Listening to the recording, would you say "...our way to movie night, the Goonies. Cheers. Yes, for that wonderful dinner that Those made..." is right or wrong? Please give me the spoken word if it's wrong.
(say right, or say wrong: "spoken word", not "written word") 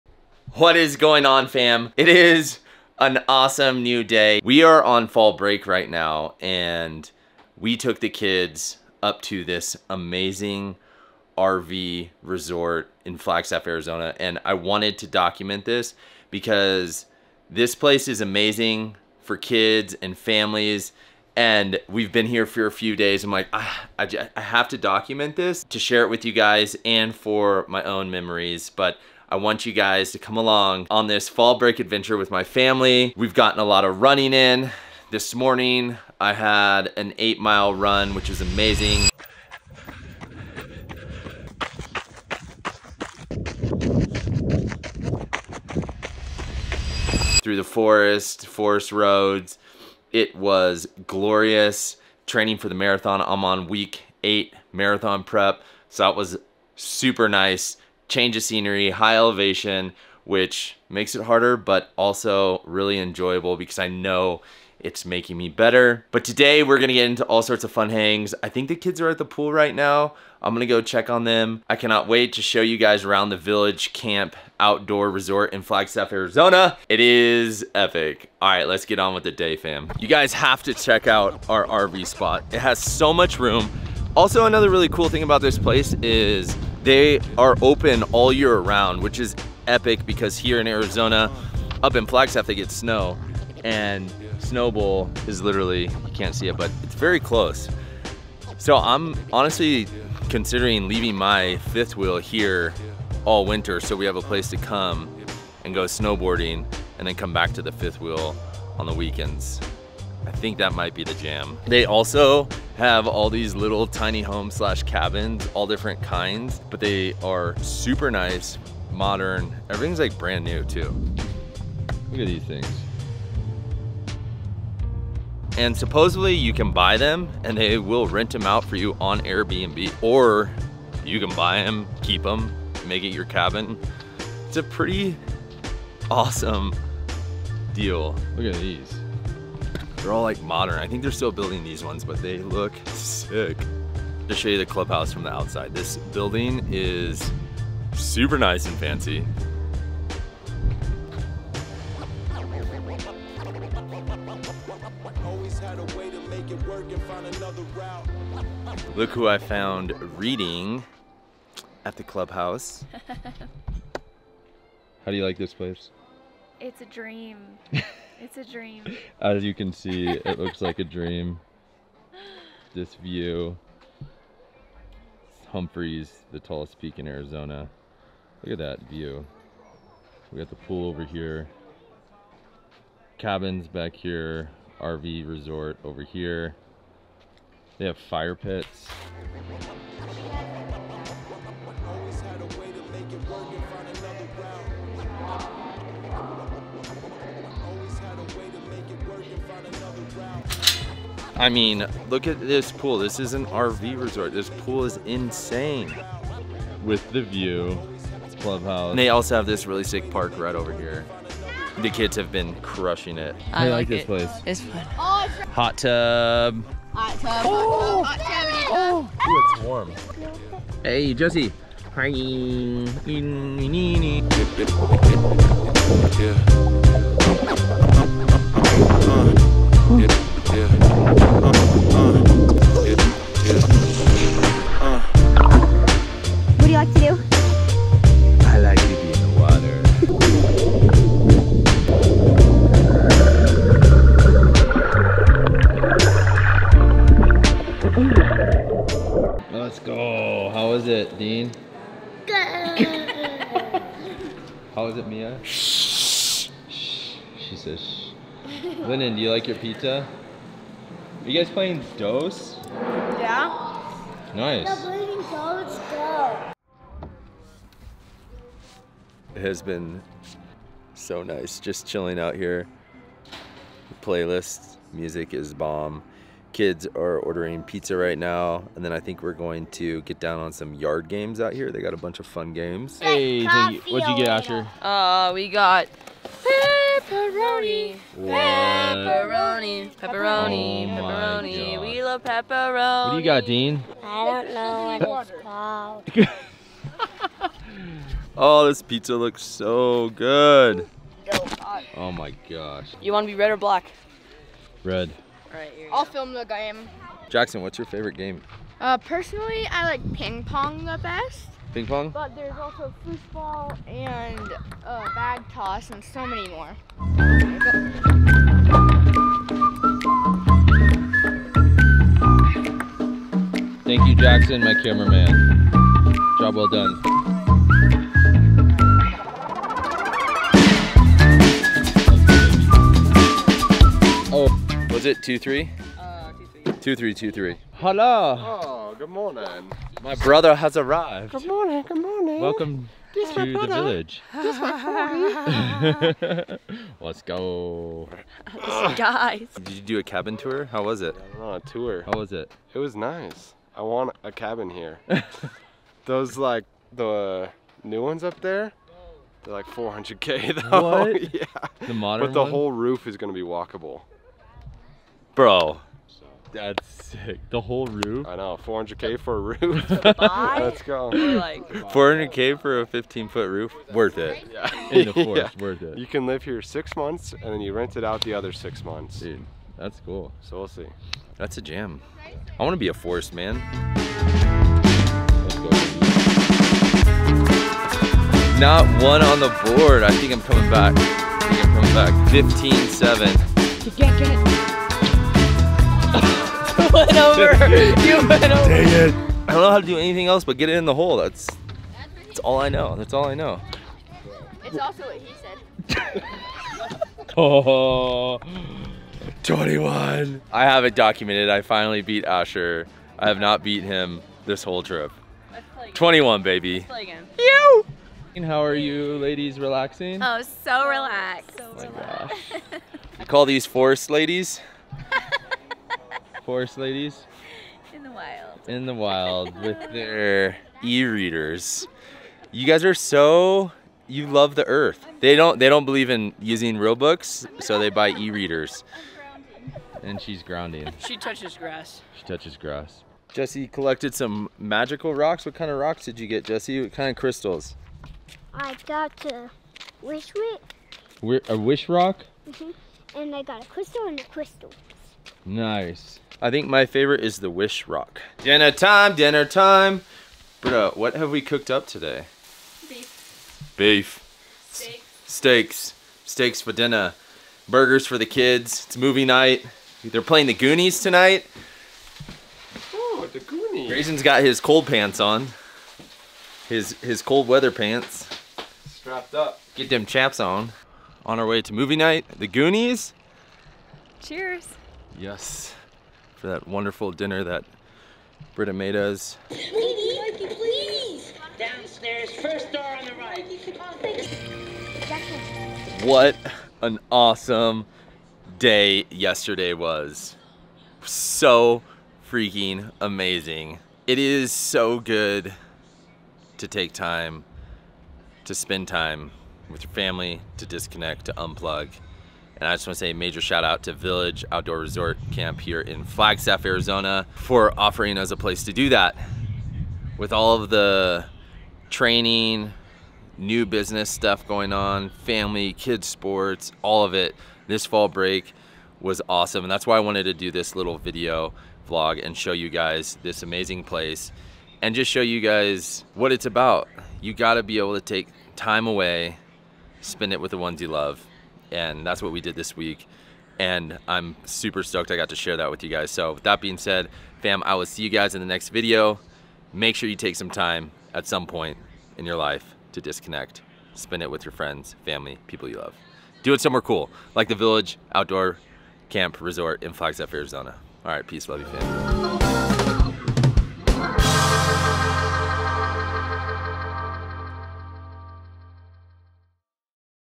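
wrong: "Britta", not "Those".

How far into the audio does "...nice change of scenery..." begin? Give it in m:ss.
0:57.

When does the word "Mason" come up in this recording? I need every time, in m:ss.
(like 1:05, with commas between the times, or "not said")
not said.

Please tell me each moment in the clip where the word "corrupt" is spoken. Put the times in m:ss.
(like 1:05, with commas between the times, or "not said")
not said.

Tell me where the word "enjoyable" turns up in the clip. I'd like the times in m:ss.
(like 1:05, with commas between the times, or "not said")
1:02.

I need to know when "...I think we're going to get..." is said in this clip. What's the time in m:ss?
4:38.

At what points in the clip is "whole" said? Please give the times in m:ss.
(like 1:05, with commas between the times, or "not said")
6:02, 6:07, 6:54.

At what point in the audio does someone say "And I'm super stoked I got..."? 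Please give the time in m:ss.
9:03.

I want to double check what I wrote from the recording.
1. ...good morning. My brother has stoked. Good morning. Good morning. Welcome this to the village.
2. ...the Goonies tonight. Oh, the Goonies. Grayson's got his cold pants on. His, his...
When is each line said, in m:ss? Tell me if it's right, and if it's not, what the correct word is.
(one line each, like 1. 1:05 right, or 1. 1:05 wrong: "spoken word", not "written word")
1. 5:38 wrong: "arrived", not "stoked"
2. 7:50 right.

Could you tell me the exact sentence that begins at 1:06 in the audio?
But today we're gonna get into all sorts of fun hangs.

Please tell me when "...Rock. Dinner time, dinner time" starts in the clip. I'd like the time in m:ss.
7:37.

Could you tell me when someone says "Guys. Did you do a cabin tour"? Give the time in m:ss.
5:48.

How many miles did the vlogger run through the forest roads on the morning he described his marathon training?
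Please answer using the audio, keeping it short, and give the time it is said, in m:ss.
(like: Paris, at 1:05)
8, at 0:37.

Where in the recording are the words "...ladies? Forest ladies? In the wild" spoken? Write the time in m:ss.
7:04.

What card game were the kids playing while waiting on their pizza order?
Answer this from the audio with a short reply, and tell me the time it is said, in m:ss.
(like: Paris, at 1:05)
DOS, at 4:21.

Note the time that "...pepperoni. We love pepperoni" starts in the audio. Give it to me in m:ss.
4:50.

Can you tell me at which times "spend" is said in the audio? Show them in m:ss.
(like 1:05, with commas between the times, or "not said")
8:28, 9:00, 9:13.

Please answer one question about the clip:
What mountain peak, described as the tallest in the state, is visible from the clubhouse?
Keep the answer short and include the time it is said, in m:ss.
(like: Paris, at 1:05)
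Humphreys, at 2:55.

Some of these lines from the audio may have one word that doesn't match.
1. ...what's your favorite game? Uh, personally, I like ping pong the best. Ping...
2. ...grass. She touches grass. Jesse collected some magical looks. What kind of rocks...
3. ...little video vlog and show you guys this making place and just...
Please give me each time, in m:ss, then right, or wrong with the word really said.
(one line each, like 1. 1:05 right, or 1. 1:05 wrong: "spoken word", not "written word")
1. 5:07 right
2. 7:21 wrong: "rocks", not "looks"
3. 8:50 wrong: "amazing", not "making".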